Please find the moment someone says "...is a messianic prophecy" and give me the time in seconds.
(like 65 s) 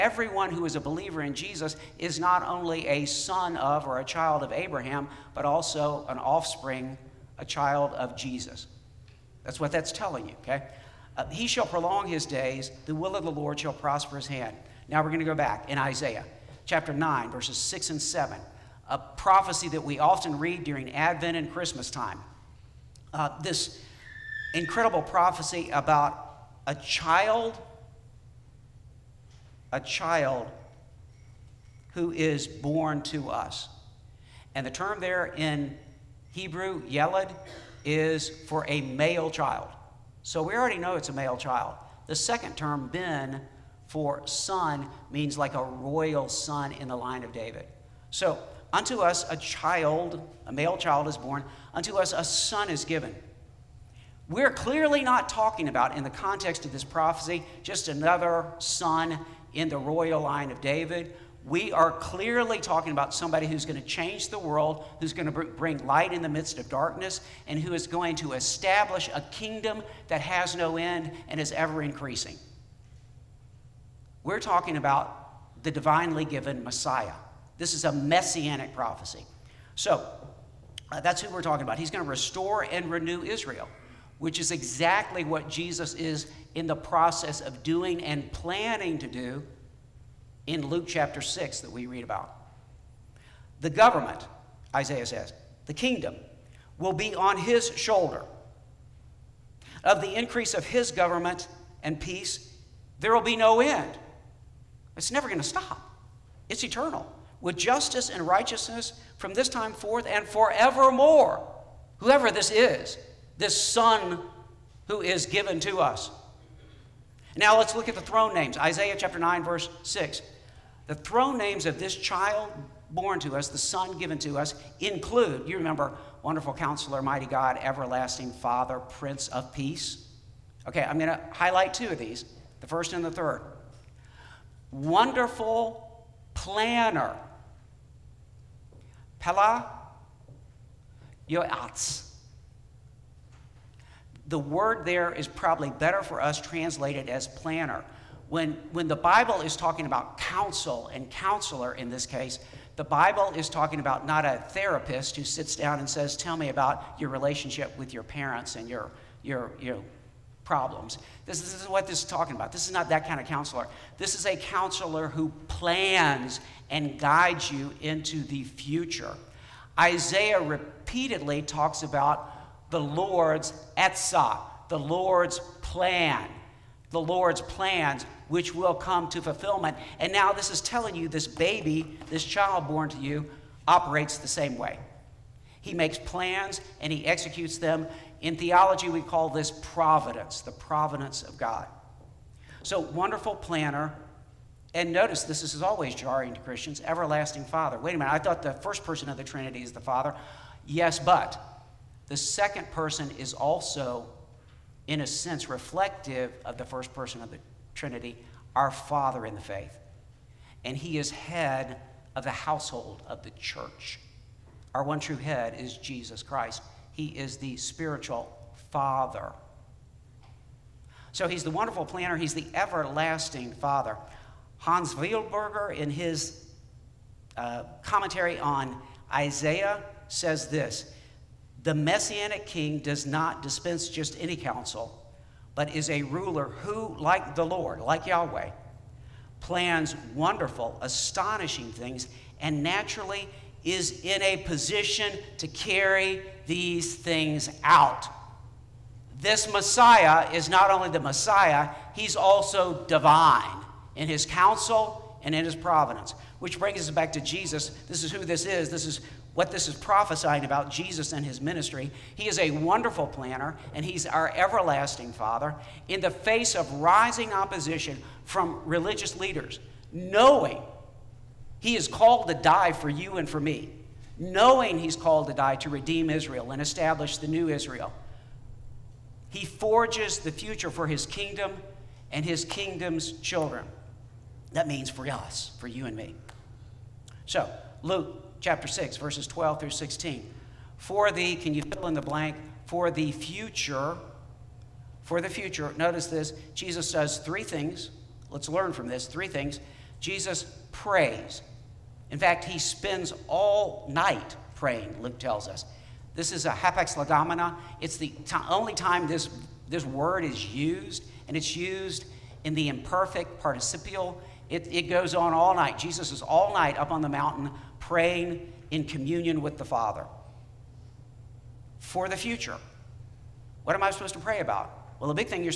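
77 s.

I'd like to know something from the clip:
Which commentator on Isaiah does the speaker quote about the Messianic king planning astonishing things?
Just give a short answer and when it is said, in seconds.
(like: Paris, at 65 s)
Hans Wildberger, at 224 s.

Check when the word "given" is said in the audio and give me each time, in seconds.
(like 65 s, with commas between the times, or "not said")
52 s, 76 s, 115 s, 123 s.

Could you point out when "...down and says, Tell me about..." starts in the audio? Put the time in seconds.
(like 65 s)
155 s.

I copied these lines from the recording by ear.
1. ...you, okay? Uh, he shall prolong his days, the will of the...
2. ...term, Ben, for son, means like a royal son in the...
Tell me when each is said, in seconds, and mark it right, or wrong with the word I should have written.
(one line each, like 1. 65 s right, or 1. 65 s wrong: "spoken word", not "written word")
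1. 10 s right
2. 42 s right.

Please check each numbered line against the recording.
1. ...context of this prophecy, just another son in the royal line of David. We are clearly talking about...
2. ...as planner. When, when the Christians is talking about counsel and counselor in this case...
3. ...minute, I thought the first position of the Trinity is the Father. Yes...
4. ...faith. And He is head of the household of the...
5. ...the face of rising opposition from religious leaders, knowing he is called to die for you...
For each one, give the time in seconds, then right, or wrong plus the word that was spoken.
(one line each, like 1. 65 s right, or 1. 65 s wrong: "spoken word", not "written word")
1. 56 s right
2. 147 s wrong: "Bible", not "Christians"
3. 197 s wrong: "person", not "position"
4. 209 s right
5. 266 s right.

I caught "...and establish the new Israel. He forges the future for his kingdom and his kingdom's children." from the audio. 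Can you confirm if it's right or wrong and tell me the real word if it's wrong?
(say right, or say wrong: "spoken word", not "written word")
right.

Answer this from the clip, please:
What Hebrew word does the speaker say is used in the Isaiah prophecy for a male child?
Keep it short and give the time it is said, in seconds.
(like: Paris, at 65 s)
Yelad, at 36 s.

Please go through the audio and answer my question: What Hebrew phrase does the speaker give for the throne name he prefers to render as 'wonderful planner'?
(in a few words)
Pele Yoetz.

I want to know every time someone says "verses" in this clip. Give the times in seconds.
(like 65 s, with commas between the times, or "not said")
17 s, 119 s, 288 s.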